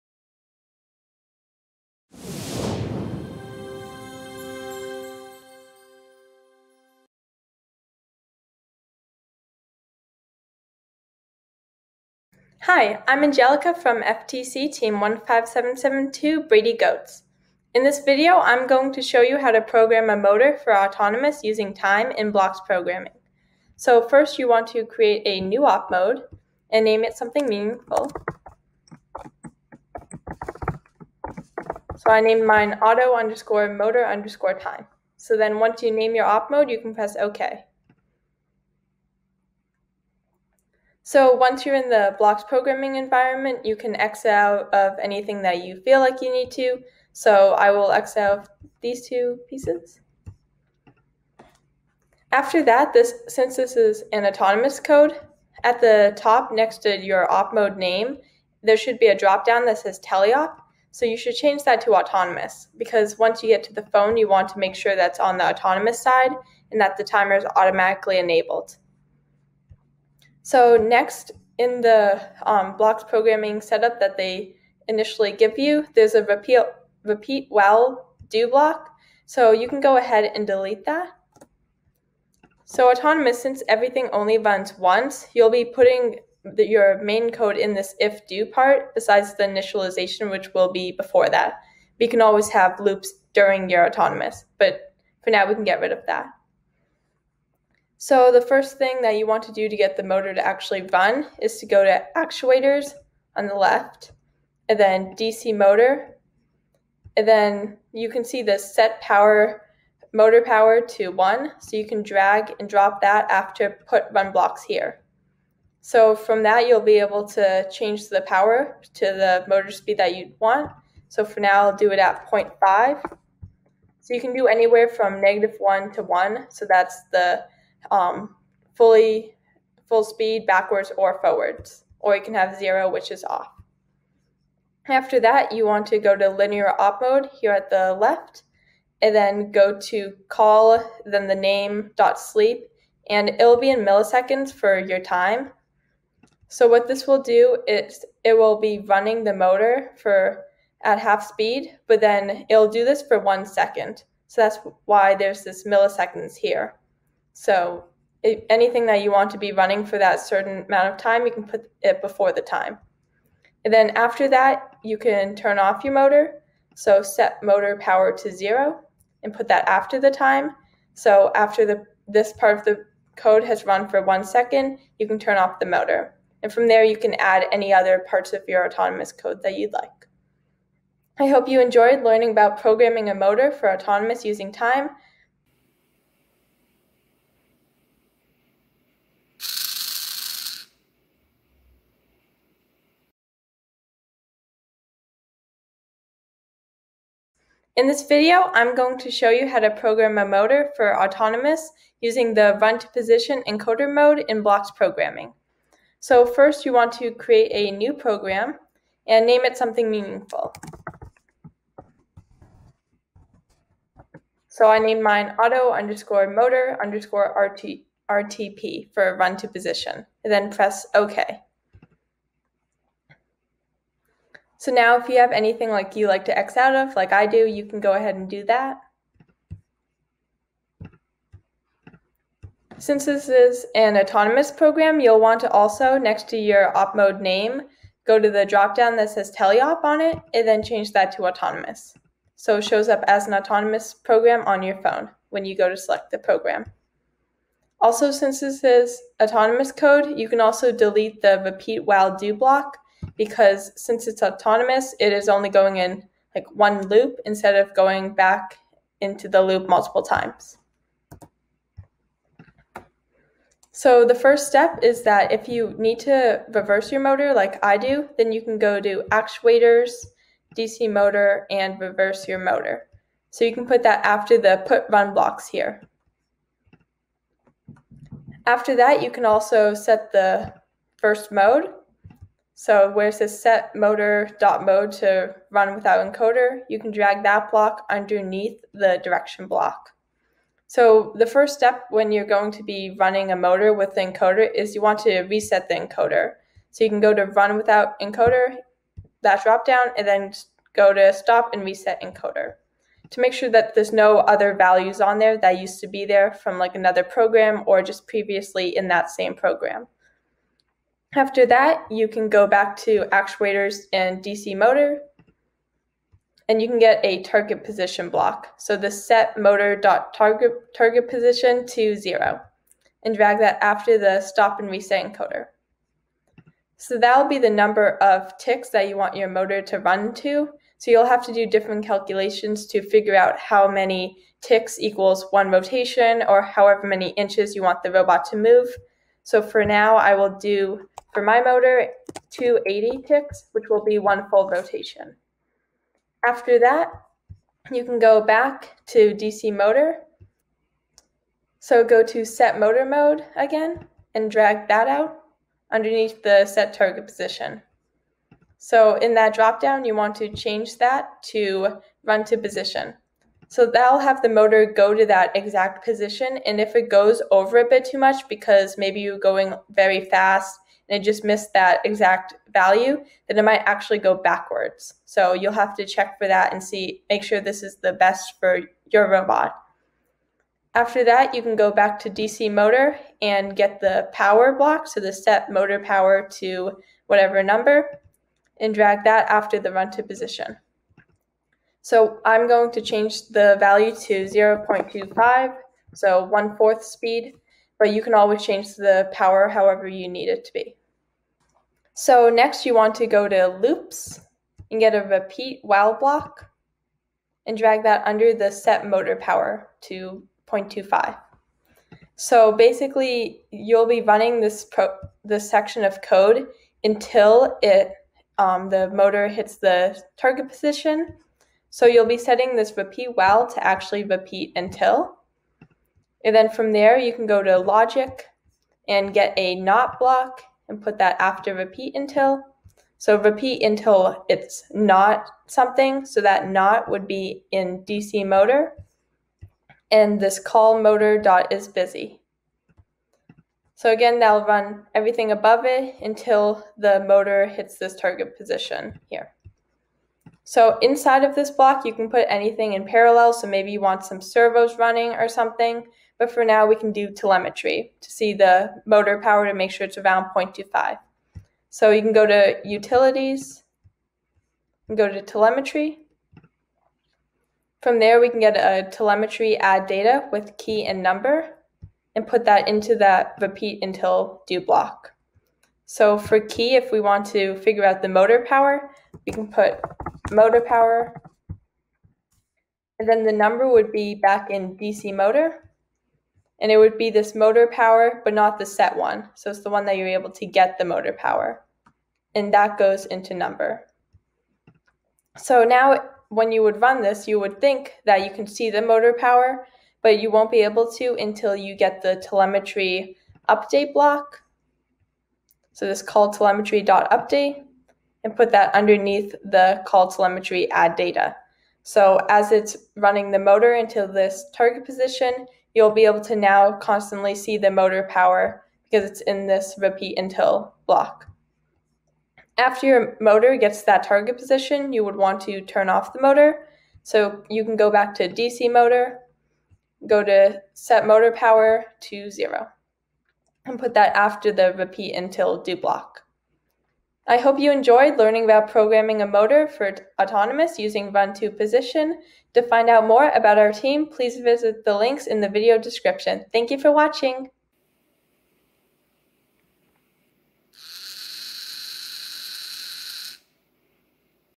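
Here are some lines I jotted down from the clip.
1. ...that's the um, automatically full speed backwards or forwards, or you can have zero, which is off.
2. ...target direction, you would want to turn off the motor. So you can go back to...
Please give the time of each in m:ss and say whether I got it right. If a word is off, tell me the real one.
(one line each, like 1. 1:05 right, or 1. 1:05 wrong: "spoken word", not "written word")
1. 2:06 wrong: "fully", not "automatically"
2. 8:44 wrong: "position", not "direction".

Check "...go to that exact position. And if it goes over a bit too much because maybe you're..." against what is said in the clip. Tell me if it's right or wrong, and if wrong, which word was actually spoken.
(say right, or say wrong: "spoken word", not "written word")
right.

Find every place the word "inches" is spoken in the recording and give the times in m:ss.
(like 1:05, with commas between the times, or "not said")
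5:37.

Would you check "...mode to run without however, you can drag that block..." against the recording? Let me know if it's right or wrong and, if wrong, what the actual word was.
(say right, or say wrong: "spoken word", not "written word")
wrong: "encoder", not "however".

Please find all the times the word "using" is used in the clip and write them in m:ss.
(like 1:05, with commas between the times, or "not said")
0:21, 3:04, 3:22, 9:00.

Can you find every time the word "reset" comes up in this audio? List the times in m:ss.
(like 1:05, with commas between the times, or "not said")
4:55, 5:01, 5:24.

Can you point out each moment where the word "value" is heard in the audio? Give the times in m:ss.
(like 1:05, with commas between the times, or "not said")
5:04, 6:12, 6:33.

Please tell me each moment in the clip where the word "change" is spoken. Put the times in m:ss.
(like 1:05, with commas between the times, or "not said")
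1:01, 1:57, 4:00, 6:00, 6:32, 6:38.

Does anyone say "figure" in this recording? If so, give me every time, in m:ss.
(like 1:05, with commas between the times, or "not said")
5:32, 7:57.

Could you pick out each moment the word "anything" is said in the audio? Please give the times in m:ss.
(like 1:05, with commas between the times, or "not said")
0:45, 2:38, 3:45, 7:32.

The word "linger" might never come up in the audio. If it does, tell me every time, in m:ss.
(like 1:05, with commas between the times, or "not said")
not said.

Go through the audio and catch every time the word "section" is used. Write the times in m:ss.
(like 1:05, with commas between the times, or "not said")
6:55.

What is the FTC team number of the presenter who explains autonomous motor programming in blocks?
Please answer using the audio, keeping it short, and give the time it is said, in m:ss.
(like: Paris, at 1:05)
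15772, at 0:14.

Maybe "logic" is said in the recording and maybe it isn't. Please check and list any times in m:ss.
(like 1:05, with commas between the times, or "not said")
7:07.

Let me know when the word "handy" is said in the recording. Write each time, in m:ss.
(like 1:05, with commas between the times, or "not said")
not said.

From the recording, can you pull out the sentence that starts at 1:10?
So next in the um, blocks programming setup that they initially give you, there's a repeat, repeat while do block.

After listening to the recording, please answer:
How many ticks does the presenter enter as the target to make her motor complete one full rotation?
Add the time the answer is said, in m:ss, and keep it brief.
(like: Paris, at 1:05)
280, at 5:42.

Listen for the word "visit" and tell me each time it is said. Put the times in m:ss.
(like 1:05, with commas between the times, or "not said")
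9:04.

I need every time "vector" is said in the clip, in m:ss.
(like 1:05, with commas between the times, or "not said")
not said.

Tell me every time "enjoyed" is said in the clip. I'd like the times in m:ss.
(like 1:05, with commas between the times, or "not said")
3:01, 8:57.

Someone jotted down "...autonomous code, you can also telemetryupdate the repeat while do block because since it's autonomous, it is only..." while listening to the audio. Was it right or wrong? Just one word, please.
wrong.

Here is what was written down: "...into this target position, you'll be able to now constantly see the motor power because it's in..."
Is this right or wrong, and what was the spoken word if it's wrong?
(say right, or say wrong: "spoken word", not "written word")
right.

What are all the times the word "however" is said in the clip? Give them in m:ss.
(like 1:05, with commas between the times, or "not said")
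5:36, 6:39.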